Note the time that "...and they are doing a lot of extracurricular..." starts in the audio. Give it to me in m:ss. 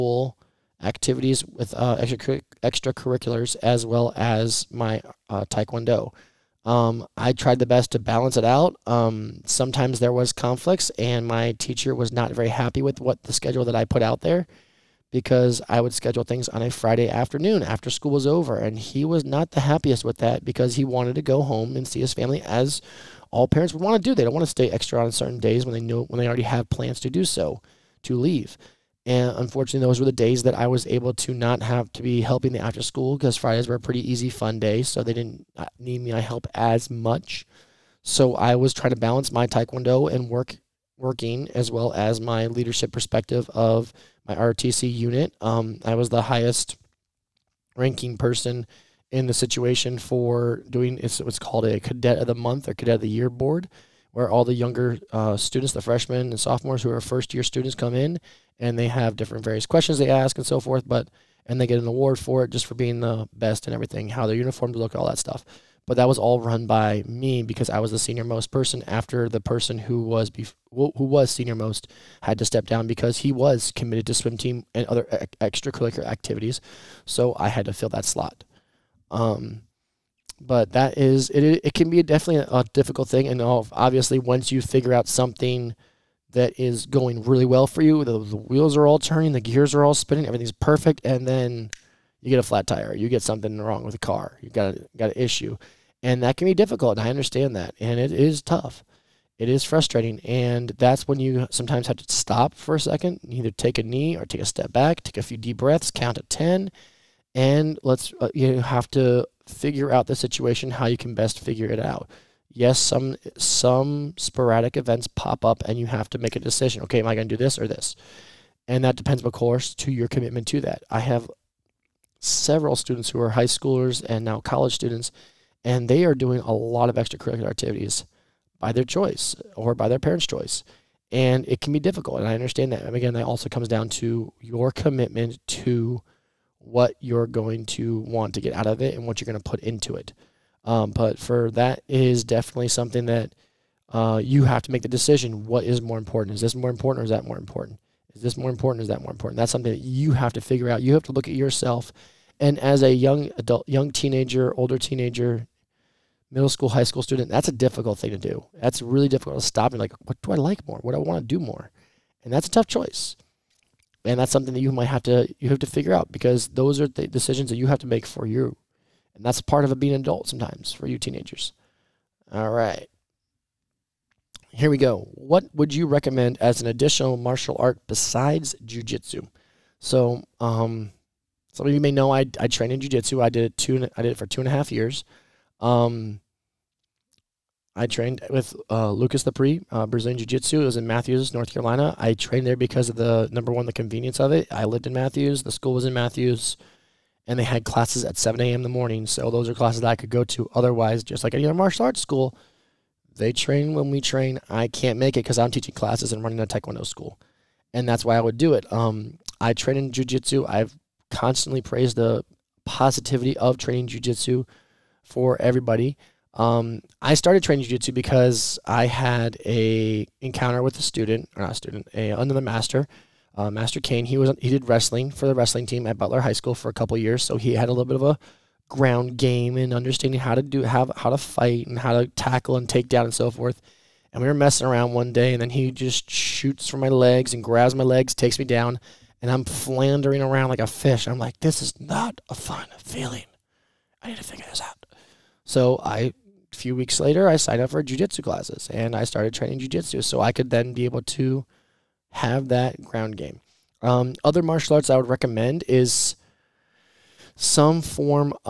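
2:05.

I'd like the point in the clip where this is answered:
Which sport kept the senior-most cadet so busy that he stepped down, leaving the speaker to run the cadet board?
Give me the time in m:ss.
1:14.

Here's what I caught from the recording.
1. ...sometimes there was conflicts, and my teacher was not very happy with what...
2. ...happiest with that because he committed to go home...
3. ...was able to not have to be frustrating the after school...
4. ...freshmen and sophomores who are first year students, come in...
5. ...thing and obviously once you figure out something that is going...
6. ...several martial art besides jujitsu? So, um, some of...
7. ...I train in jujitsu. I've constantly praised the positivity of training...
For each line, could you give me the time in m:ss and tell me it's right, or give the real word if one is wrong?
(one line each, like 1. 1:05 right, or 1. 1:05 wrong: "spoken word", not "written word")
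1. 0:09 right
2. 0:19 wrong: "wanted", not "committed"
3. 0:30 wrong: "helping", not "frustrating"
4. 0:55 right
5. 1:23 right
6. 2:56 wrong: "additional", not "several"
7. 3:29 right.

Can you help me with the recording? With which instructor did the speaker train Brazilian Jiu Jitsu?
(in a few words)
Lucas Lepri.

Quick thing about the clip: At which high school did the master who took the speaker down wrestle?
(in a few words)
Butler High School.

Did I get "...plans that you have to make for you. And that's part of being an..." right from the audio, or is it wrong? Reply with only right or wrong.
wrong.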